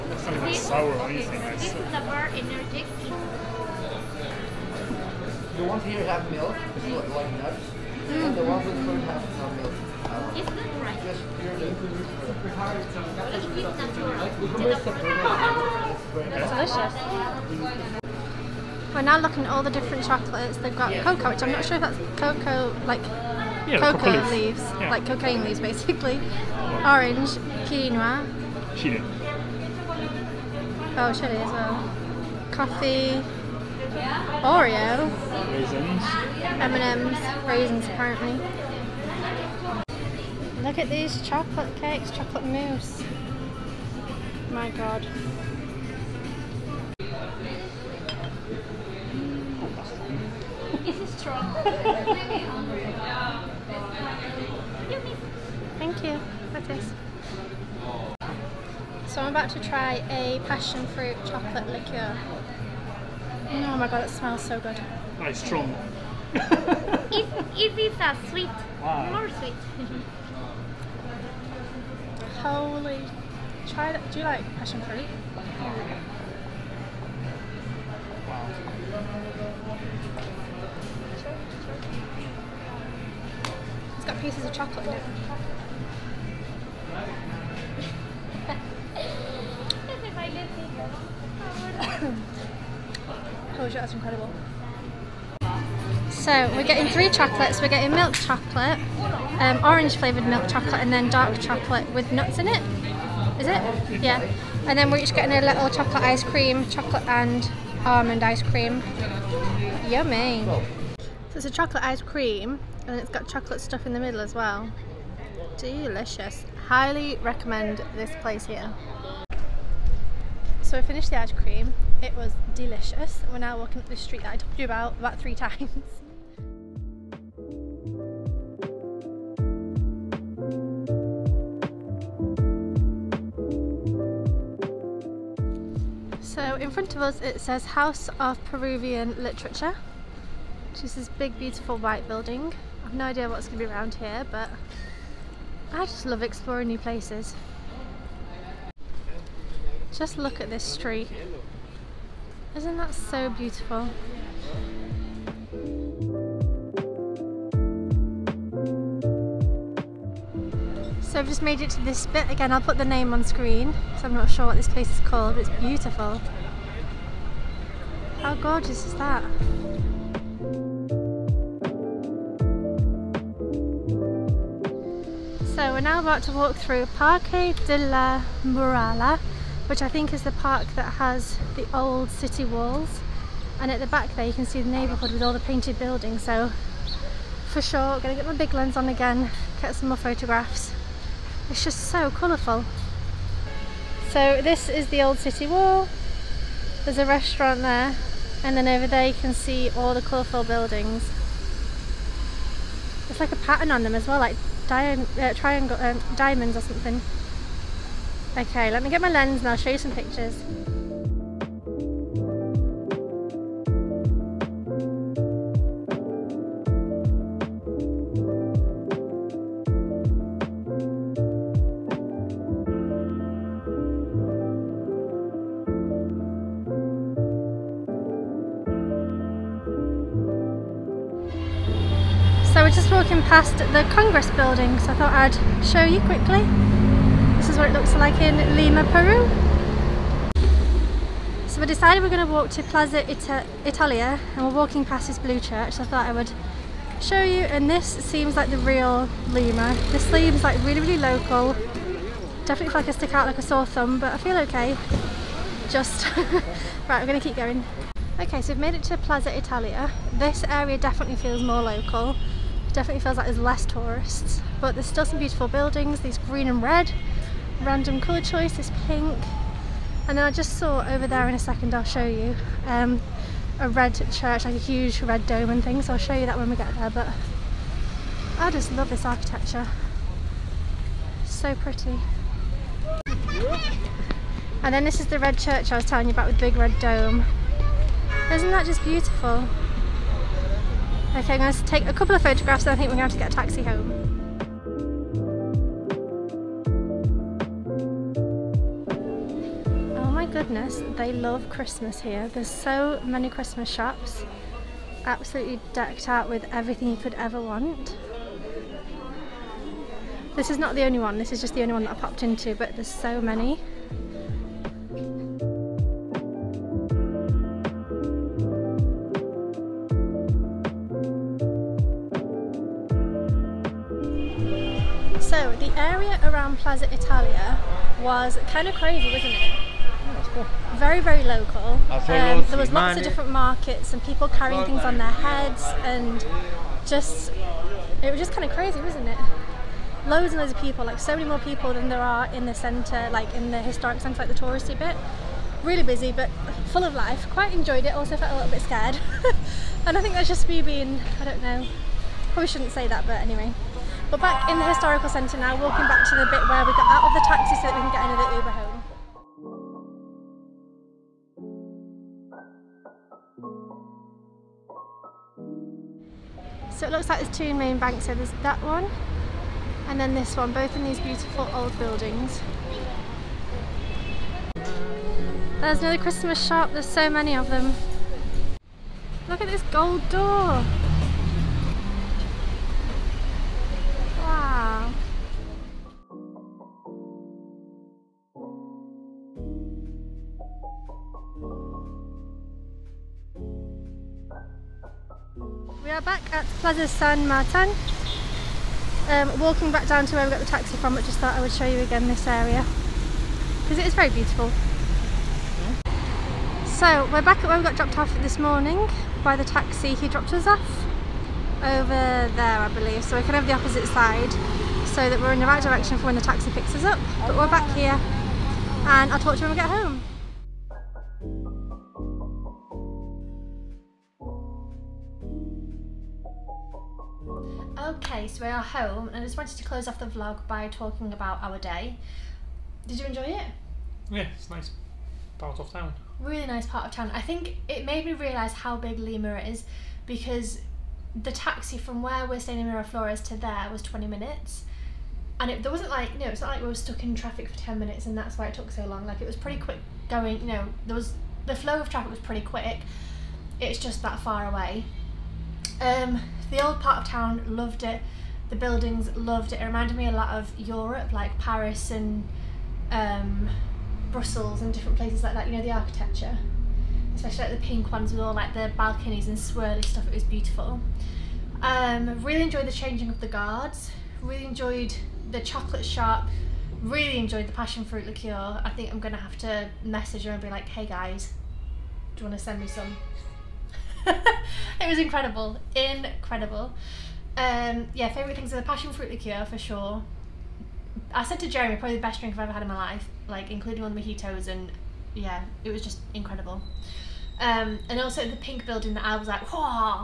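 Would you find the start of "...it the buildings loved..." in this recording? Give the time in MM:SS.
07:37.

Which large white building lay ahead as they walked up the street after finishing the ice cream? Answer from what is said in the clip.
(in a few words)
House of Peruvian Literature.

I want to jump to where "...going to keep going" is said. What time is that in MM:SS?
04:17.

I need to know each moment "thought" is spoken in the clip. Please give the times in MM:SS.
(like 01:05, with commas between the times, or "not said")
03:54, 04:05, 06:41.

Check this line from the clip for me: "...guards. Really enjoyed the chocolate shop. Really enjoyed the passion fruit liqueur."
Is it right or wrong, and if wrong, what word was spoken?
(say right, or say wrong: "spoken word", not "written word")
right.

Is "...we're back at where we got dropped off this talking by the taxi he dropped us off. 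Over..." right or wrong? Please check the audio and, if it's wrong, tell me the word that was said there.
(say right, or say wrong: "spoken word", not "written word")
wrong: "morning", not "talking".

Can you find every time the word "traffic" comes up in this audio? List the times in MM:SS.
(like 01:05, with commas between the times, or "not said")
07:27, 07:31.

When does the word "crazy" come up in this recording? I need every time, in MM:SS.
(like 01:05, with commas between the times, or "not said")
05:28, 05:38.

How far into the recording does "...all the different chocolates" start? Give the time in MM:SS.
00:19.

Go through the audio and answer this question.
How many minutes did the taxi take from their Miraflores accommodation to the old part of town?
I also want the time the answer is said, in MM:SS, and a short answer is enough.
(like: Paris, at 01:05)
20, at 07:23.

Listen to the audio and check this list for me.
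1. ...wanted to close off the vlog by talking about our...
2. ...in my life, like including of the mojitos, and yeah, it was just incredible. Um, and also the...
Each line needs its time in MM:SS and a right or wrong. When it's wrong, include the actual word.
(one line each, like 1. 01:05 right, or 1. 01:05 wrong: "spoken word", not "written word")
1. 07:09 right
2. 08:12 right.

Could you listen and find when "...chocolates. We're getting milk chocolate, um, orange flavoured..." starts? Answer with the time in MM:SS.
01:37.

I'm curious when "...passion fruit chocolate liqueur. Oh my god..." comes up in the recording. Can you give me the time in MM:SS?
01:00.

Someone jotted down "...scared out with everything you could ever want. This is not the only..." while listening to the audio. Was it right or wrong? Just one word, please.
wrong.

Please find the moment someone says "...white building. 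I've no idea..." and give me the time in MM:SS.
02:21.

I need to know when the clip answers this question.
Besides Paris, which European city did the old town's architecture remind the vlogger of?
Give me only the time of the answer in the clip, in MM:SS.
07:44.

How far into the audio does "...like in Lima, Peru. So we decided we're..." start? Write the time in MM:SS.
03:57.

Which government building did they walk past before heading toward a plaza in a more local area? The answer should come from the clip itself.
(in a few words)
Congress building.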